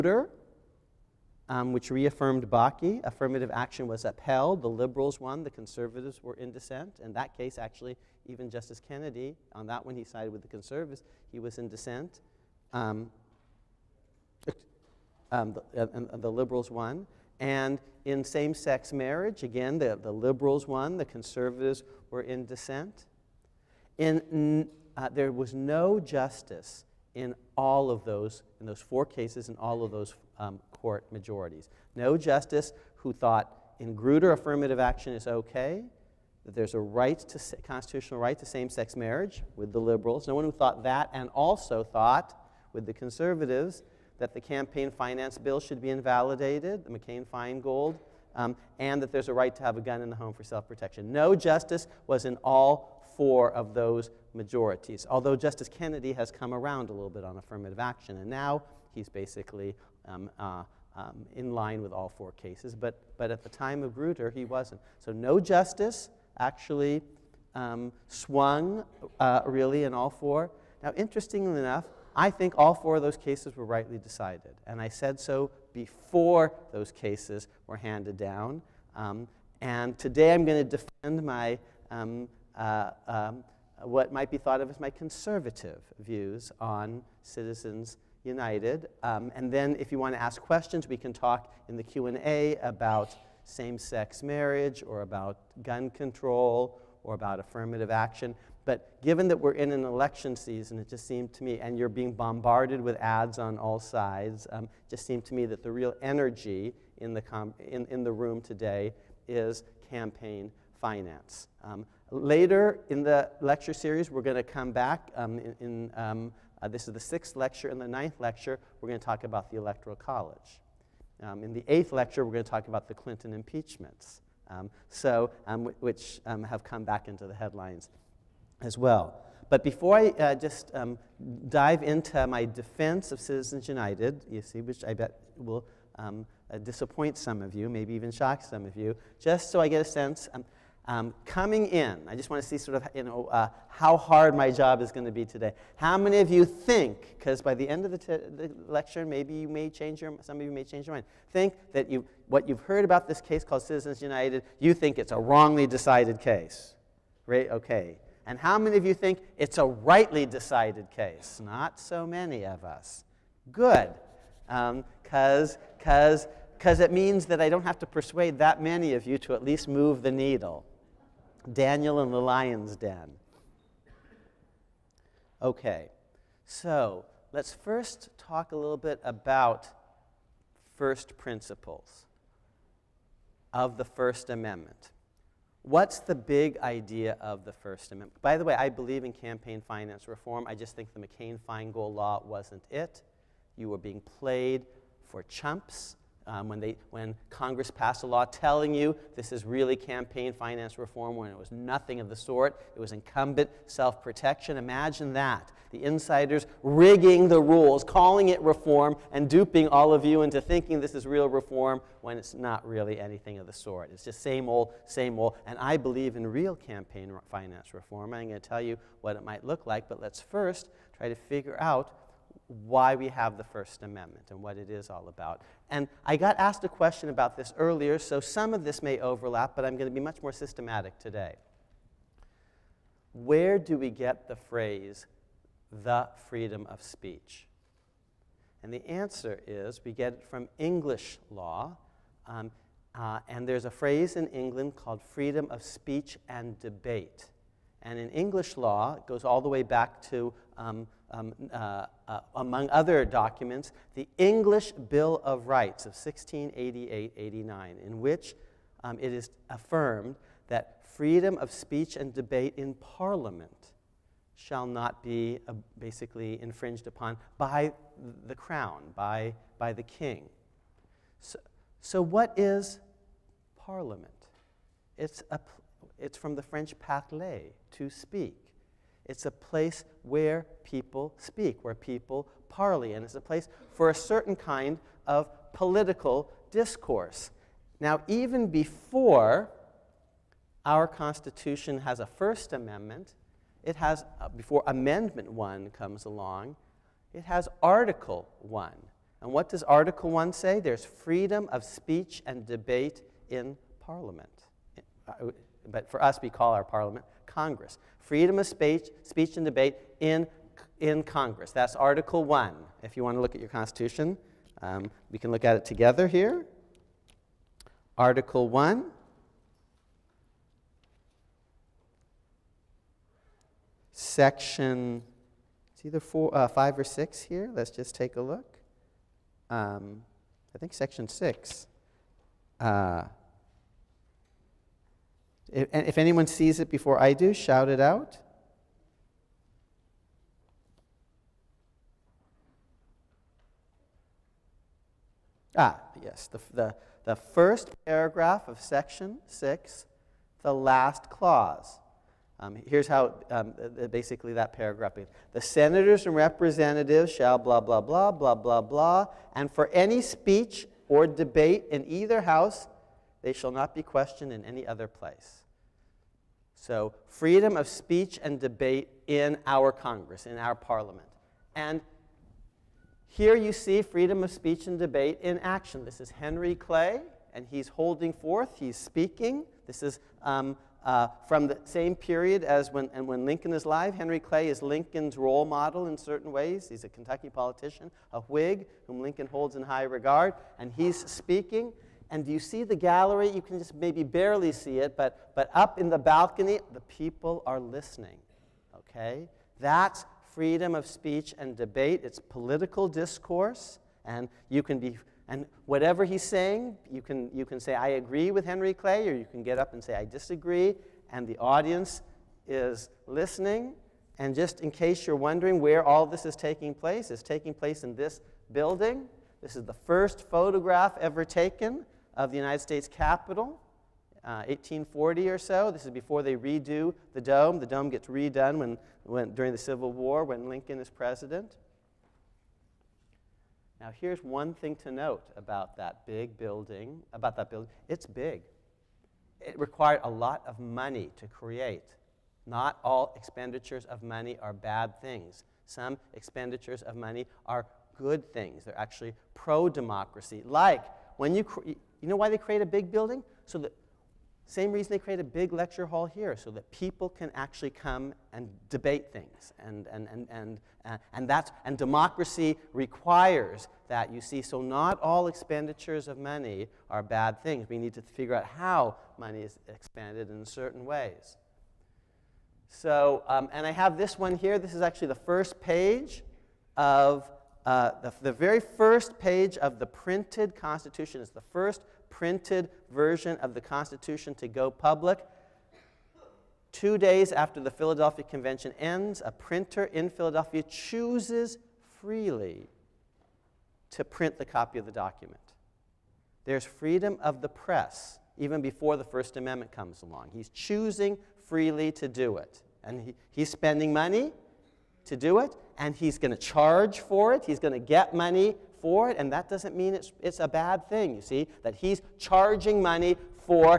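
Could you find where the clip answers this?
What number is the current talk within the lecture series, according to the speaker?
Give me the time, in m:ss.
1:56.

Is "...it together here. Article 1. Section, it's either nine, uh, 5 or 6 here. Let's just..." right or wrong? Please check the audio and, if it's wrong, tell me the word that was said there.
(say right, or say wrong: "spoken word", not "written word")
wrong: "four", not "nine".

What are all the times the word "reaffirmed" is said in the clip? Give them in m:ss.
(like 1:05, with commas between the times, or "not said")
0:01.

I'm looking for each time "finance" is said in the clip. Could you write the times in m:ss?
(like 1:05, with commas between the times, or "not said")
0:44, 1:50, 3:09, 3:20, 3:37.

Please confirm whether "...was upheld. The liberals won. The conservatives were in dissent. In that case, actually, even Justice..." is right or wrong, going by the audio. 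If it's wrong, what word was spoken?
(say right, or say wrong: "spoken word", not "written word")
right.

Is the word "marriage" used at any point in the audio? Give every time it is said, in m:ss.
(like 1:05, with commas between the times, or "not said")
0:18, 0:38, 1:34.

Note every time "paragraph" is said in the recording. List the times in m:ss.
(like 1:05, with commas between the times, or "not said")
5:47, 5:54.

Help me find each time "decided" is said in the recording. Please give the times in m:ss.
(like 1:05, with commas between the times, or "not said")
1:13, 2:35, 2:40.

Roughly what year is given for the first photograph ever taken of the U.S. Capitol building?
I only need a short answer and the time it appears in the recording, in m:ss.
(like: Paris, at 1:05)
1840, at 7:04.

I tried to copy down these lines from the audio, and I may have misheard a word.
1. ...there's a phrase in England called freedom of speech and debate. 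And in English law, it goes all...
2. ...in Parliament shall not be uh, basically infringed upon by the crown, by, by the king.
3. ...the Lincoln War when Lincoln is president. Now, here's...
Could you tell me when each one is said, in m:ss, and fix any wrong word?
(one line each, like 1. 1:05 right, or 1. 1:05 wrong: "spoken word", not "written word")
1. 4:03 right
2. 4:22 right
3. 7:09 wrong: "Civil", not "Lincoln".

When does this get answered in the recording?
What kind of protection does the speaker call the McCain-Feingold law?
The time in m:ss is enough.
3:22.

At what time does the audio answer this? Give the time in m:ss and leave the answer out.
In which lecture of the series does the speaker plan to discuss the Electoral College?
1:57.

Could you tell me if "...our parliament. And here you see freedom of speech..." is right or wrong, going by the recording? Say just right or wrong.
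right.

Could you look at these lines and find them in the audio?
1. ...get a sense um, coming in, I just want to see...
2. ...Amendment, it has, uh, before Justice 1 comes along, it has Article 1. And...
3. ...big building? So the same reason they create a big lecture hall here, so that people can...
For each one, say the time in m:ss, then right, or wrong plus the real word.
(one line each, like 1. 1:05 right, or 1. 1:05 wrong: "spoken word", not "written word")
1. 2:19 right
2. 4:52 wrong: "Amendment", not "Justice"
3. 7:32 right.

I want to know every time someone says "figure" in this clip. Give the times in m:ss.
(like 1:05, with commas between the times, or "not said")
3:41, 7:48.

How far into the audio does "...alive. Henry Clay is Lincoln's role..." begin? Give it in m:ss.
6:23.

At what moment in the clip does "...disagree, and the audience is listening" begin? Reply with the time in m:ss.
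6:50.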